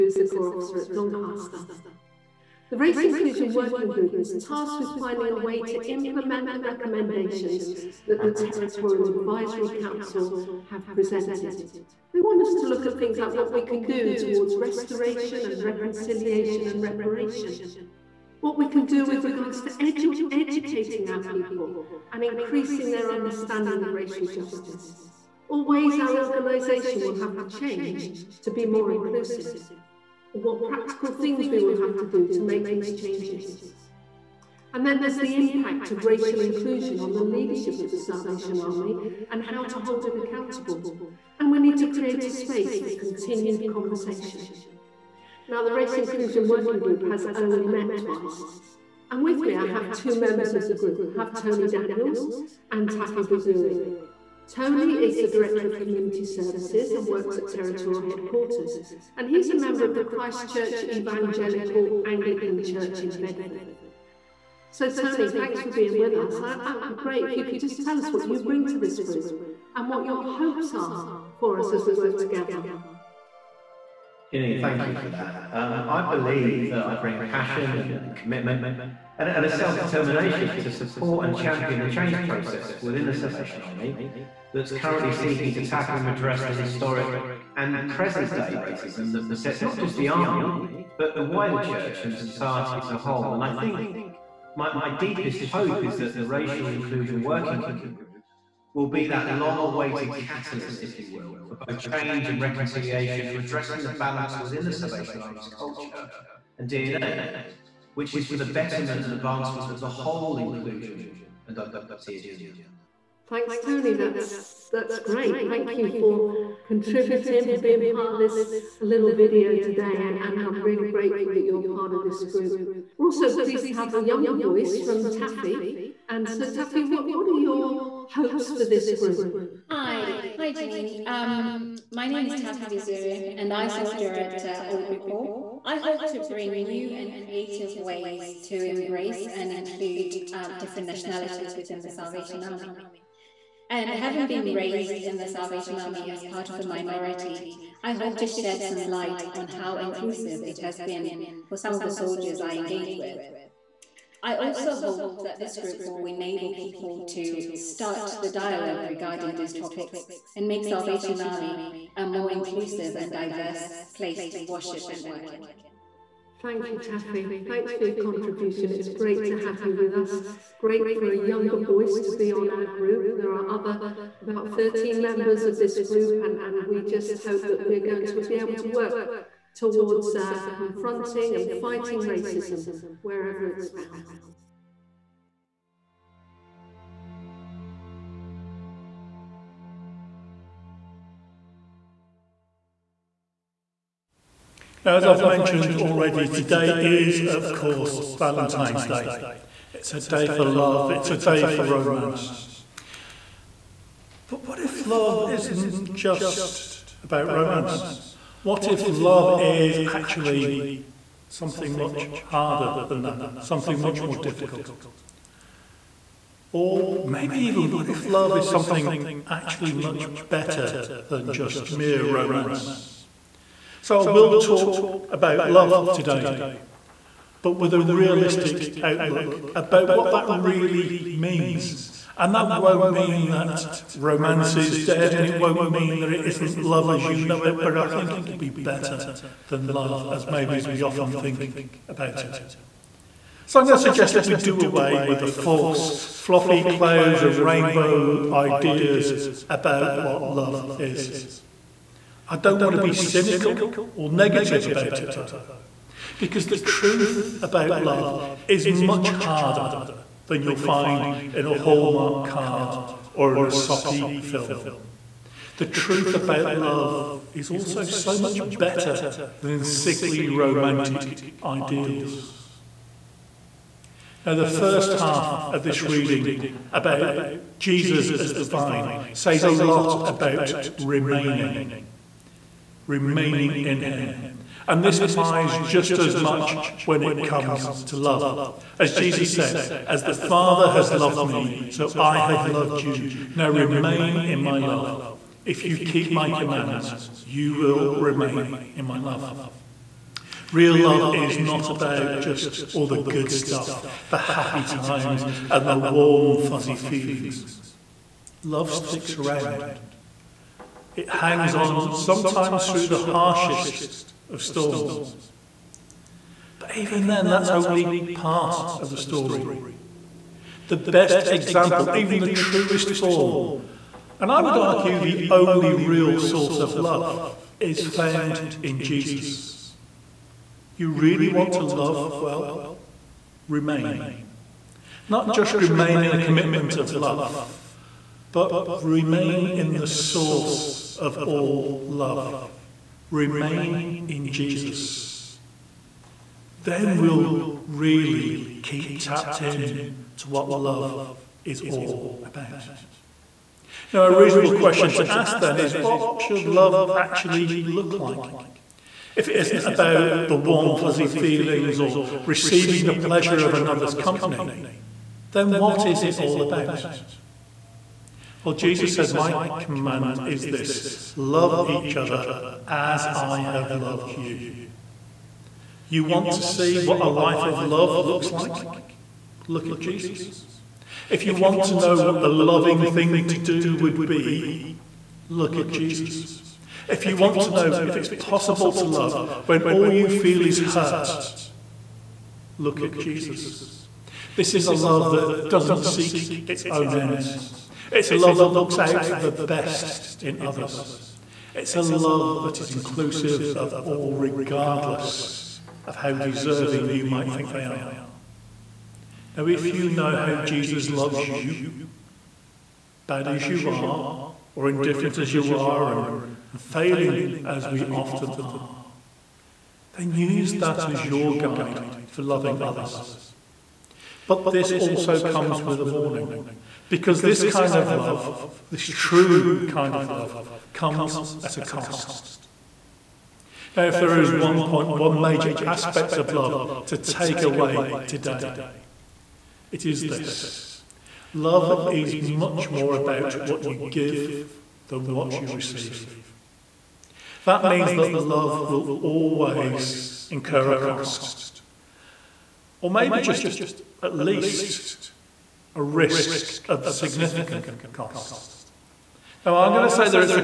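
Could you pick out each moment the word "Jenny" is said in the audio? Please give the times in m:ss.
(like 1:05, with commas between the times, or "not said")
1:14.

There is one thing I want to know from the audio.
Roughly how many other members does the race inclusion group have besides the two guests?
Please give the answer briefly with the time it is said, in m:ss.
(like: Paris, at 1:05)
13, at 2:54.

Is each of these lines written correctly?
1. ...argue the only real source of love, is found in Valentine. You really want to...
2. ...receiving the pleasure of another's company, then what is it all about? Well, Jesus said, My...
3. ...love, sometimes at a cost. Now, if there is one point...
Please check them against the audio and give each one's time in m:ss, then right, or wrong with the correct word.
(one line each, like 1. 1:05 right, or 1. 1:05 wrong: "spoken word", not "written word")
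1. 5:24 wrong: "Jesus", not "Valentine"
2. 6:02 right
3. 7:10 wrong: "comes", not "sometimes".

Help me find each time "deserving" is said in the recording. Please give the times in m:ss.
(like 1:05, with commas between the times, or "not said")
6:46.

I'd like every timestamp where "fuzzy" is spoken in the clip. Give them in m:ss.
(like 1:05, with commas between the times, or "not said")
5:06, 6:00.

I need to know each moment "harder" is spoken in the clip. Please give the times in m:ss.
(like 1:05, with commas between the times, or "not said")
3:32, 4:19.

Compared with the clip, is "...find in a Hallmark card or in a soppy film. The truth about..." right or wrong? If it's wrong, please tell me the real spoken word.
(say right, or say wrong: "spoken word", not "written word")
right.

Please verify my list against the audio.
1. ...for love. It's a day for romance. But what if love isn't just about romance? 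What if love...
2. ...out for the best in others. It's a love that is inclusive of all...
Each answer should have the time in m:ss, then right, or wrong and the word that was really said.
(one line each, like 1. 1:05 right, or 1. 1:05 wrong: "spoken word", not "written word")
1. 3:20 right
2. 6:38 right.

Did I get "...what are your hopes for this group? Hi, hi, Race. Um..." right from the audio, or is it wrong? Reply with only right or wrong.
wrong.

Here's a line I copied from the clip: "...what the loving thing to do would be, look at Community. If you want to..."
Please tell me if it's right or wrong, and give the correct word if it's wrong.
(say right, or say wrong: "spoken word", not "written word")
wrong: "Jesus", not "Community".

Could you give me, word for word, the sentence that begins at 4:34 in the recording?
Now, the first half of this reading about Jesus as the vine says a lot about remaining, remaining in Him.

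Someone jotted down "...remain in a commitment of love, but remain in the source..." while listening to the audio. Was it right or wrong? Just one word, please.
right.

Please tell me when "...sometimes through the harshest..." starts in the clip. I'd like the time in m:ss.
5:11.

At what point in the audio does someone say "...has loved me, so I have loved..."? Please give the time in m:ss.
4:50.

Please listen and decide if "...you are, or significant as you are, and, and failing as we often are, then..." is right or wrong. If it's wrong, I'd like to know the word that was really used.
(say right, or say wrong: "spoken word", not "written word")
wrong: "indifferent", not "significant".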